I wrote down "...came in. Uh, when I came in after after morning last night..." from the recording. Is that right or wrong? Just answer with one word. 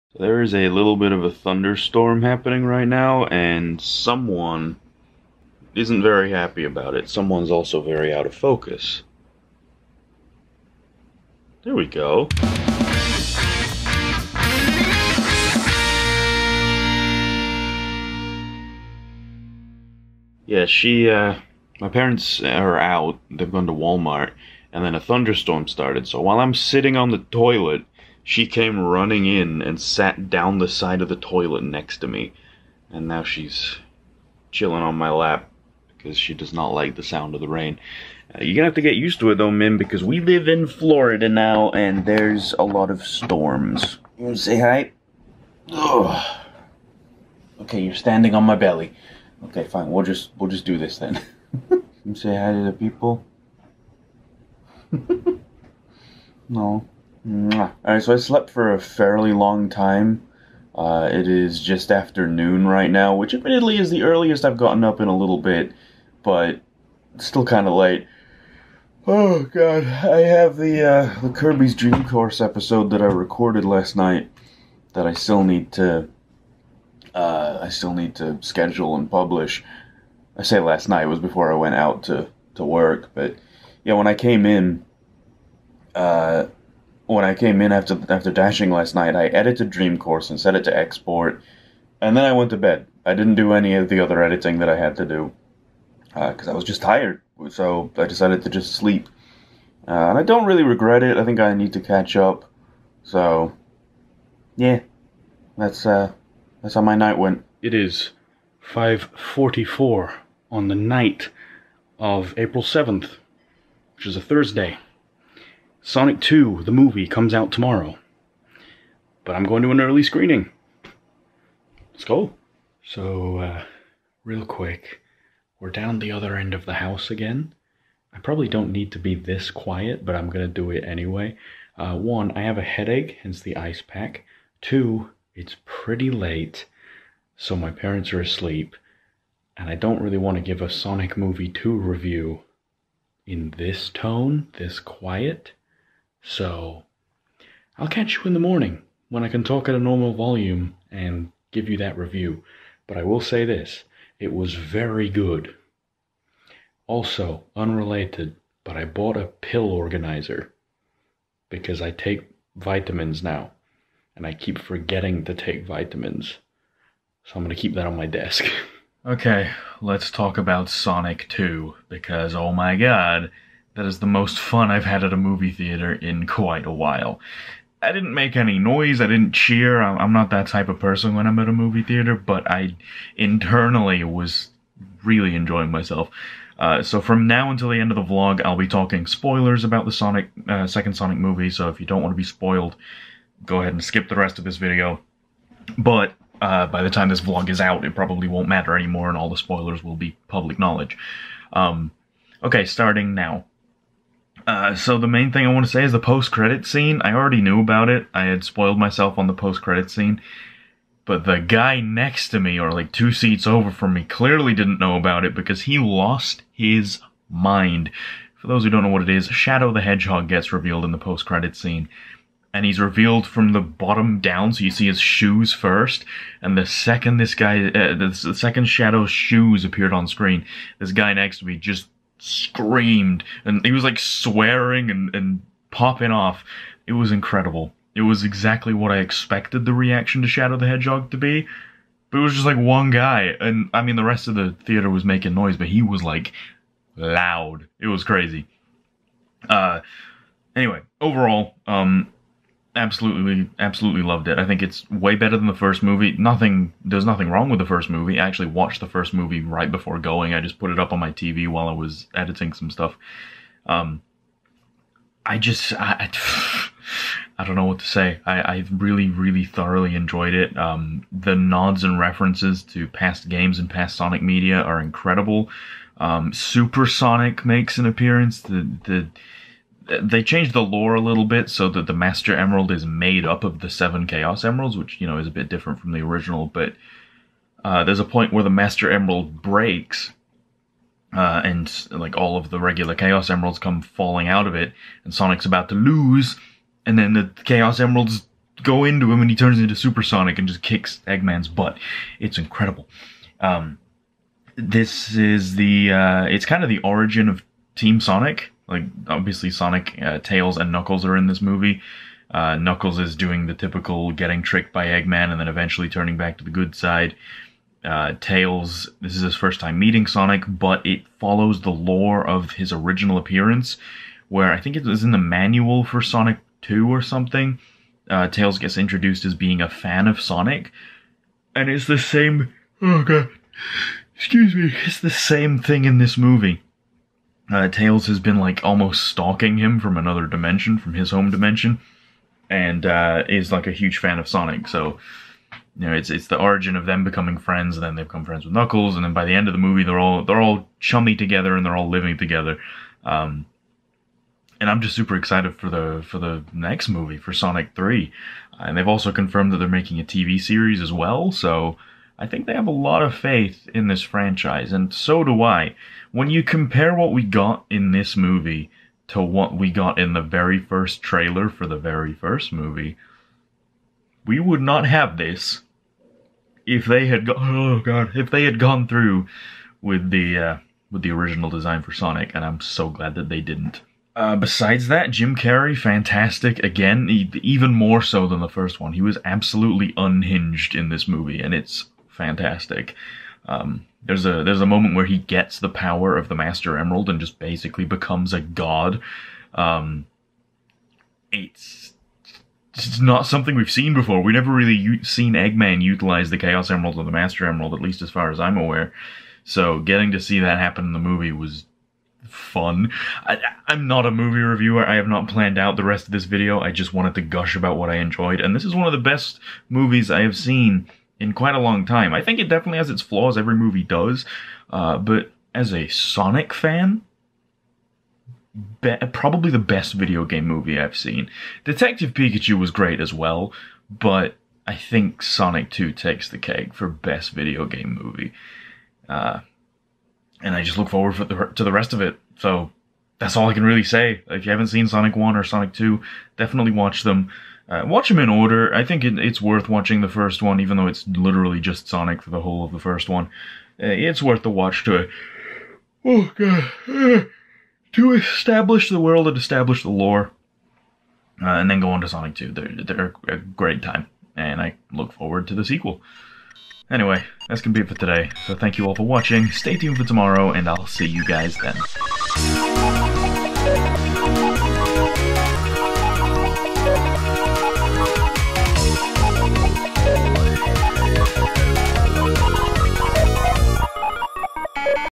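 wrong.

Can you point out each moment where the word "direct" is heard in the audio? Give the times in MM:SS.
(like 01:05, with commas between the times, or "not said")
not said.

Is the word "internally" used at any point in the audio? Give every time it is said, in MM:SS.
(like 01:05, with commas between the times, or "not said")
03:03.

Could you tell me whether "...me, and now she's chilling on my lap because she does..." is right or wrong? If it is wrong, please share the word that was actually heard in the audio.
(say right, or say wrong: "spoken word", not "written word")
right.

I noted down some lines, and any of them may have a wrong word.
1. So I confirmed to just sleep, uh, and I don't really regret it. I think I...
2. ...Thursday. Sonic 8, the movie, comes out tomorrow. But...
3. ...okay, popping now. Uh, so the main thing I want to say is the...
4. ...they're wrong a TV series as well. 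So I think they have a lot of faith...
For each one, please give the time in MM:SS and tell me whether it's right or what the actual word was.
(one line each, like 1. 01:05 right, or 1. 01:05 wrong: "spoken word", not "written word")
1. 01:37 wrong: "decided", not "confirmed"
2. 01:54 wrong: "2", not "8"
3. 03:22 wrong: "starting", not "popping"
4. 05:59 wrong: "making", not "wrong".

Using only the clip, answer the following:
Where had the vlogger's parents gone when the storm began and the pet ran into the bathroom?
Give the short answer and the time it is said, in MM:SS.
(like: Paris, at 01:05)
Walmart, at 00:23.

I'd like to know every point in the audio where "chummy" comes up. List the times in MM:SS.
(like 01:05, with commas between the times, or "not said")
05:50.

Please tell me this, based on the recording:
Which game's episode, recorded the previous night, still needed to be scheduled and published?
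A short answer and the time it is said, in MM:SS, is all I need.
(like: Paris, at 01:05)
Kirby's Dream Course, at 01:11.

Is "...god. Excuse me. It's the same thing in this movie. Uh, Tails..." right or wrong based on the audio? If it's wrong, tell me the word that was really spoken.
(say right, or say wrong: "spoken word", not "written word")
right.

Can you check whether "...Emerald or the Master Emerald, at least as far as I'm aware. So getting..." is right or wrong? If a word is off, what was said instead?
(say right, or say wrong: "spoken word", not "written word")
right.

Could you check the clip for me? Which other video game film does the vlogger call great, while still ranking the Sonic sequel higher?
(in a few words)
Detective Pikachu.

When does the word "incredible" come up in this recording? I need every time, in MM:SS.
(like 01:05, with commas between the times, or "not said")
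03:57, 04:34, 05:02.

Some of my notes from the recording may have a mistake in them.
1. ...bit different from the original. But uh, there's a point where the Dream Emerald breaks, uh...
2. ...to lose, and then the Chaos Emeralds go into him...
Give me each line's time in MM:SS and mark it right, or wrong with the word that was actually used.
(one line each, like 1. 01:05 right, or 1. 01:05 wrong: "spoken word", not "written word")
1. 04:45 wrong: "Master", not "Dream"
2. 04:55 right.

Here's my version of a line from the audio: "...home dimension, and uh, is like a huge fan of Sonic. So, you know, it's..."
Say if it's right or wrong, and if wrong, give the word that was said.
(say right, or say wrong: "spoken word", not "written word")
right.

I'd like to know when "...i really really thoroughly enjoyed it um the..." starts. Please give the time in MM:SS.
04:28.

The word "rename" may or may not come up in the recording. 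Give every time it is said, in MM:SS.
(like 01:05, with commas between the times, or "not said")
not said.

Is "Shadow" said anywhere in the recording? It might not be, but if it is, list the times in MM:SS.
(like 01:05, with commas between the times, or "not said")
03:39, 03:48, 04:00.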